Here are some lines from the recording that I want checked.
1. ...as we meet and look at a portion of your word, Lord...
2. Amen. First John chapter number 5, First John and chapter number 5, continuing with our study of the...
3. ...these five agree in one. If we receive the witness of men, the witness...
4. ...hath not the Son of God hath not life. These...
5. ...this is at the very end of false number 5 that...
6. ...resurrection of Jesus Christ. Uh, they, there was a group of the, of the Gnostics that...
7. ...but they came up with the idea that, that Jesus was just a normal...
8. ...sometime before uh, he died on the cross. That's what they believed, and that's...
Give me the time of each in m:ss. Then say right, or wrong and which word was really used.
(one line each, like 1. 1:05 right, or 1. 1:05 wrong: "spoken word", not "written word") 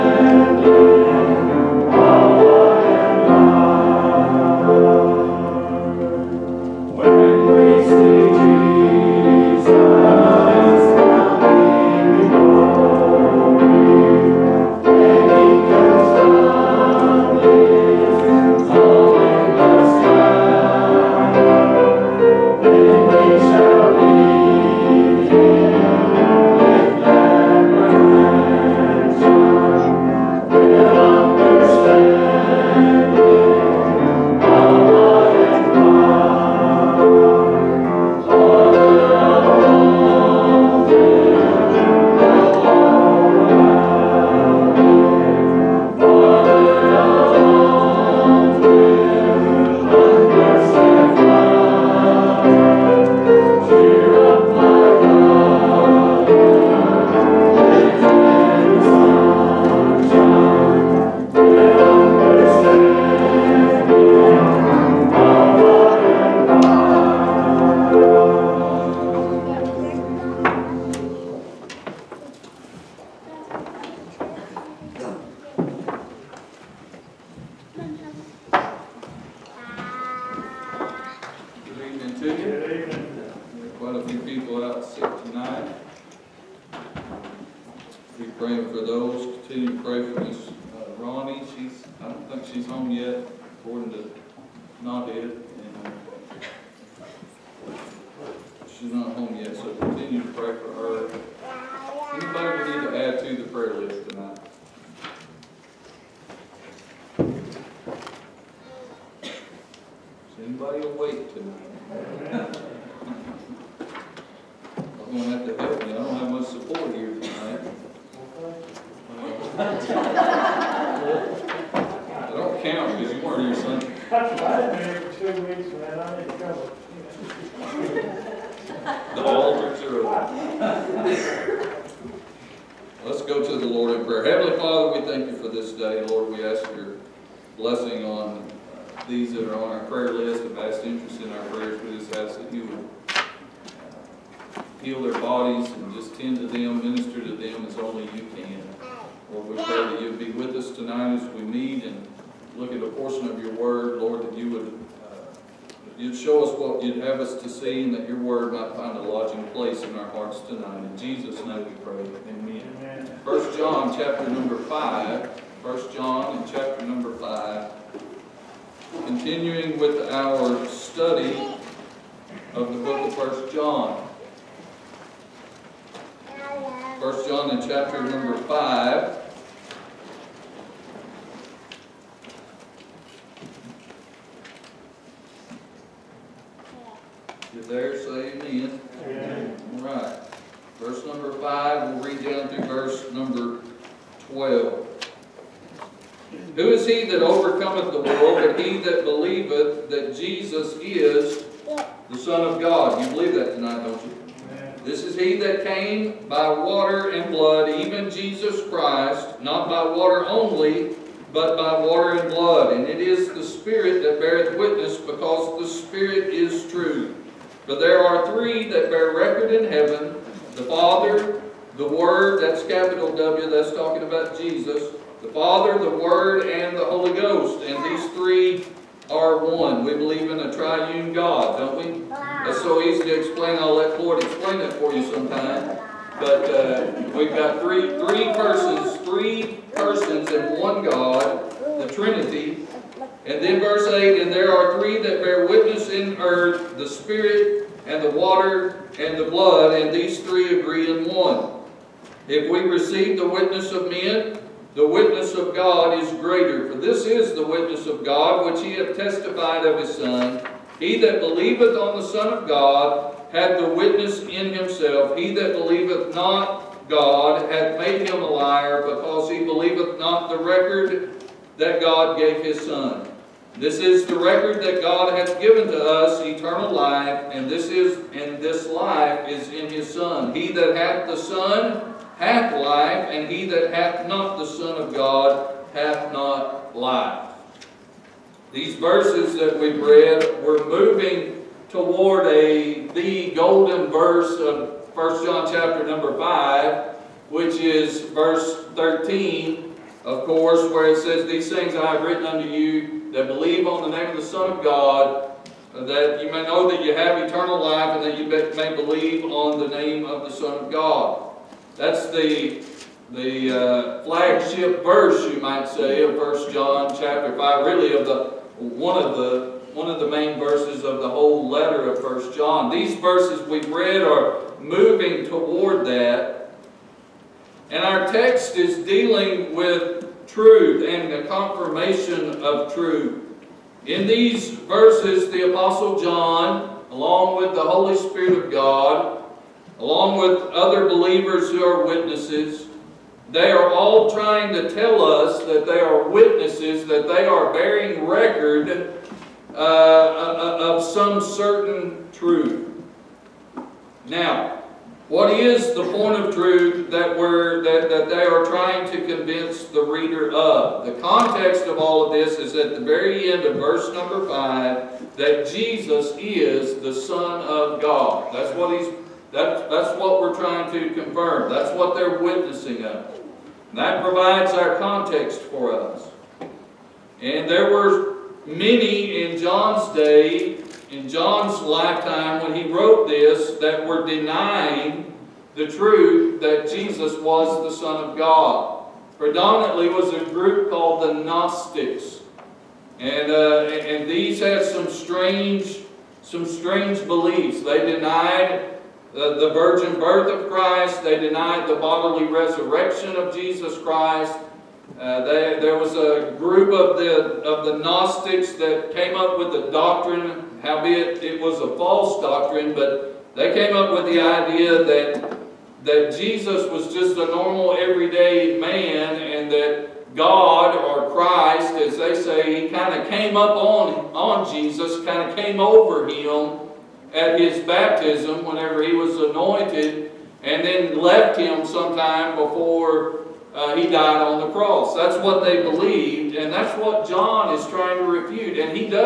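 1. 2:31 right
2. 2:42 right
3. 4:09 wrong: "three", not "five"
4. 4:43 right
5. 6:02 wrong: "verse", not "false"
6. 6:42 right
7. 6:52 right
8. 7:11 right.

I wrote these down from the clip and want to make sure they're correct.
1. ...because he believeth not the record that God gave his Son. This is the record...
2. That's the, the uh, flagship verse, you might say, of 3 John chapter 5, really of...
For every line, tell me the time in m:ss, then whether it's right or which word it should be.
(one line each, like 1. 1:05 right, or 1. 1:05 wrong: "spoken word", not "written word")
1. 4:28 right
2. 5:11 wrong: "1", not "3".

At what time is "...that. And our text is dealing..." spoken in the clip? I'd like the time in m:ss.
5:25.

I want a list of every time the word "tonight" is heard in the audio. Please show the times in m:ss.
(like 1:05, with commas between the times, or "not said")
2:30, 2:40, 3:23.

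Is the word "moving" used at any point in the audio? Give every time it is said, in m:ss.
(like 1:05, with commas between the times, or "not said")
4:50, 5:24.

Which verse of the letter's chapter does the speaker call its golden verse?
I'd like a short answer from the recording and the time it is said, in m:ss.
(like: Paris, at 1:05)
13, at 4:58.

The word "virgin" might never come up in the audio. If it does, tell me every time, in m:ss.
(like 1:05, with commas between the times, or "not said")
6:39.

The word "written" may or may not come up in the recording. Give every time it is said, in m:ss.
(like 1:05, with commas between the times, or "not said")
5:02.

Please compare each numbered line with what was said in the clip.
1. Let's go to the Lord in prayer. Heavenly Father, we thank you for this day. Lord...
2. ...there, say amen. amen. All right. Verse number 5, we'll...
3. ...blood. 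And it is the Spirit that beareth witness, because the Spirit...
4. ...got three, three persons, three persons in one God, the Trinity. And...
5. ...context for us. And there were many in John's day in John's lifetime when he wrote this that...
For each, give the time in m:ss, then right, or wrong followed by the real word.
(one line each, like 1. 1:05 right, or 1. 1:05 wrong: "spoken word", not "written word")
1. 2:13 right
2. 3:07 right
3. 3:32 right
4. 3:57 right
5. 6:14 right.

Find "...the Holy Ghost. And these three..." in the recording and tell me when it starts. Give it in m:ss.
3:46.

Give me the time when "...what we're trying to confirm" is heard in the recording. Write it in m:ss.
6:10.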